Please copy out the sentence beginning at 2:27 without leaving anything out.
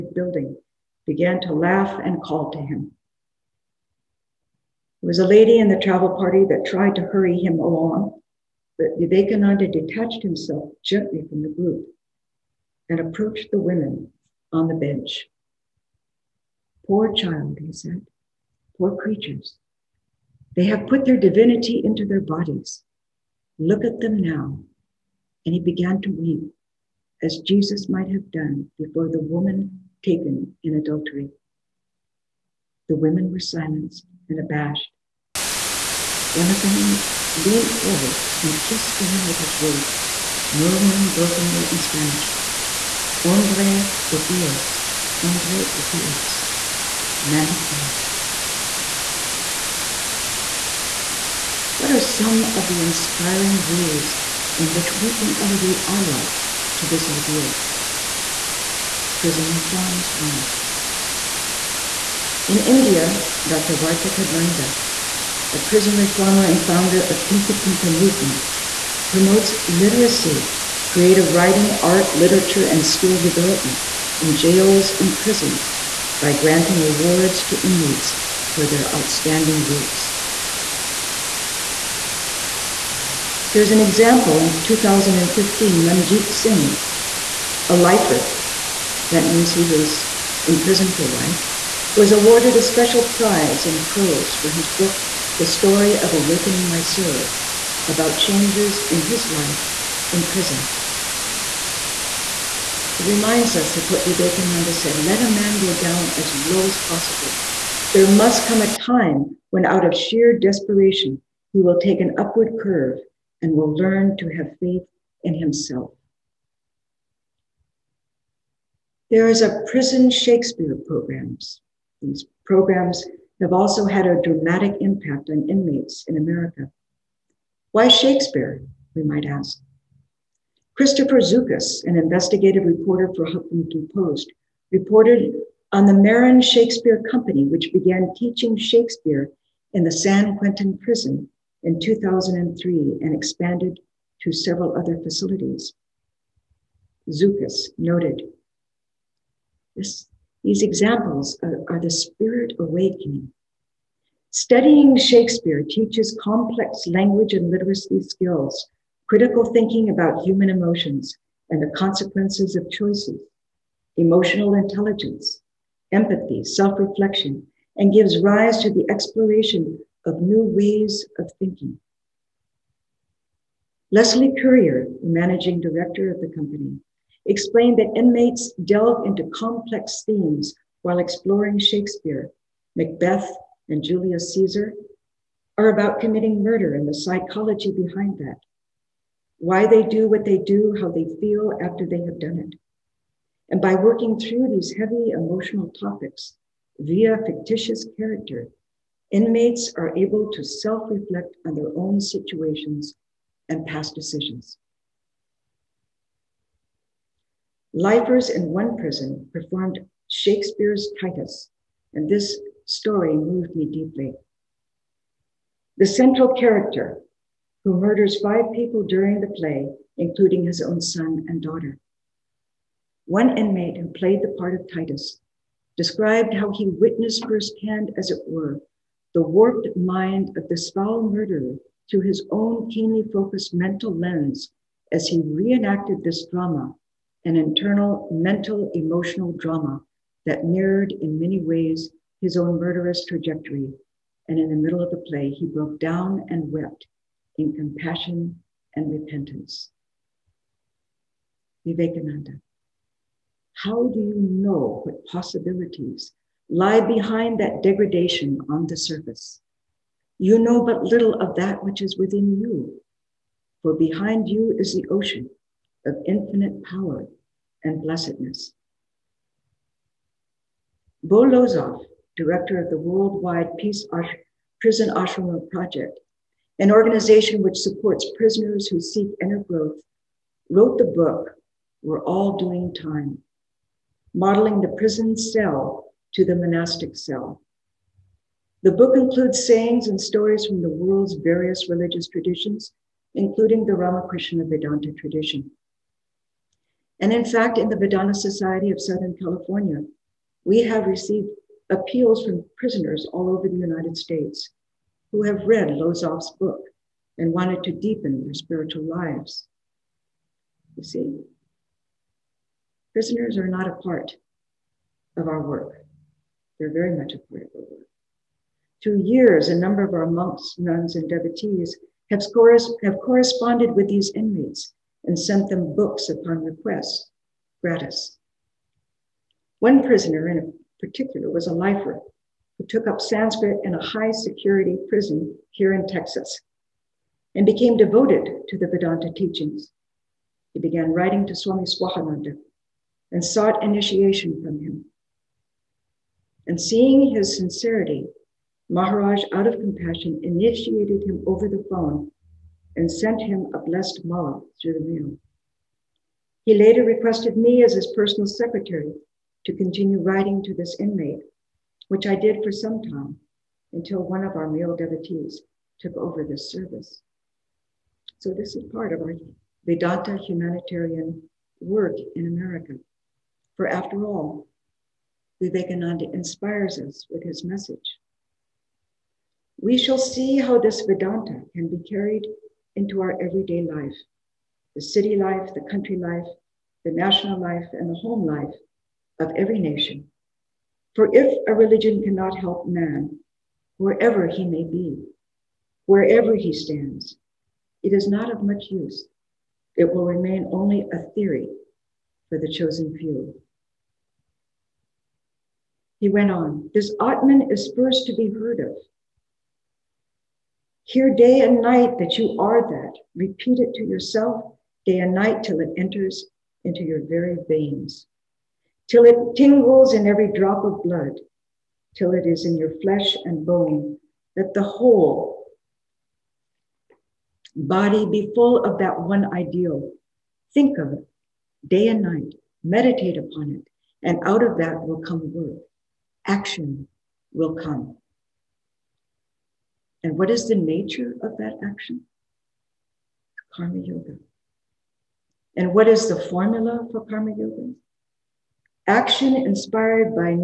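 Zoukis noted this, these examples are, are the spirit awakening.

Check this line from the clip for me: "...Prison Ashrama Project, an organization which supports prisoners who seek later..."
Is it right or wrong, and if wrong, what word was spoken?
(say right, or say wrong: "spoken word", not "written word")
wrong: "inner", not "later".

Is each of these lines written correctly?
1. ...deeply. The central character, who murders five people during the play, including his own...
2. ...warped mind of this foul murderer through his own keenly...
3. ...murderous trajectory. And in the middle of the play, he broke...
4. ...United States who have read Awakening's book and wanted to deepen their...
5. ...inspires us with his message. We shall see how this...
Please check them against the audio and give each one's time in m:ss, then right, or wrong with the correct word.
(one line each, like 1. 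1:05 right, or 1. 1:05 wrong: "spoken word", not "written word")
1. 3:33 right
2. 3:49 right
3. 4:02 right
4. 5:03 wrong: "Lozoff", not "Awakening"
5. 6:16 right.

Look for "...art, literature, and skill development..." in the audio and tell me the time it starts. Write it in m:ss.
1:11.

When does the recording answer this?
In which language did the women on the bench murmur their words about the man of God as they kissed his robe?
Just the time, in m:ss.
0:41.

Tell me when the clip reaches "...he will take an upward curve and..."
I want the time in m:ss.
1:51.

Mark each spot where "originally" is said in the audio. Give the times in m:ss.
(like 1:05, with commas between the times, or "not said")
not said.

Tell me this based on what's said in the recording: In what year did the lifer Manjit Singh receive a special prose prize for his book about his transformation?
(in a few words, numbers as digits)
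2015.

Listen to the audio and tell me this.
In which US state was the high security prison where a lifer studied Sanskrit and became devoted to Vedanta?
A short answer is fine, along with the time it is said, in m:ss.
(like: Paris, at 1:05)
Texas, at 5:35.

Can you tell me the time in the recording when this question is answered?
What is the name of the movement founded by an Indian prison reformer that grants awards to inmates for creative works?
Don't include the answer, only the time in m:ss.
1:07.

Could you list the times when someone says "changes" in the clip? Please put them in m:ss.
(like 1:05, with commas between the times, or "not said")
1:38.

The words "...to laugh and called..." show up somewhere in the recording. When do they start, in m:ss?
0:01.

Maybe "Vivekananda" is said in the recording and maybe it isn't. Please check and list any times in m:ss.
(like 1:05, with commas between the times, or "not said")
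0:08, 1:44, 4:11, 6:15.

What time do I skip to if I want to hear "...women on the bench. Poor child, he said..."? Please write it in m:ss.
0:13.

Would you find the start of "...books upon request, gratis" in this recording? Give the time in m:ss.
5:25.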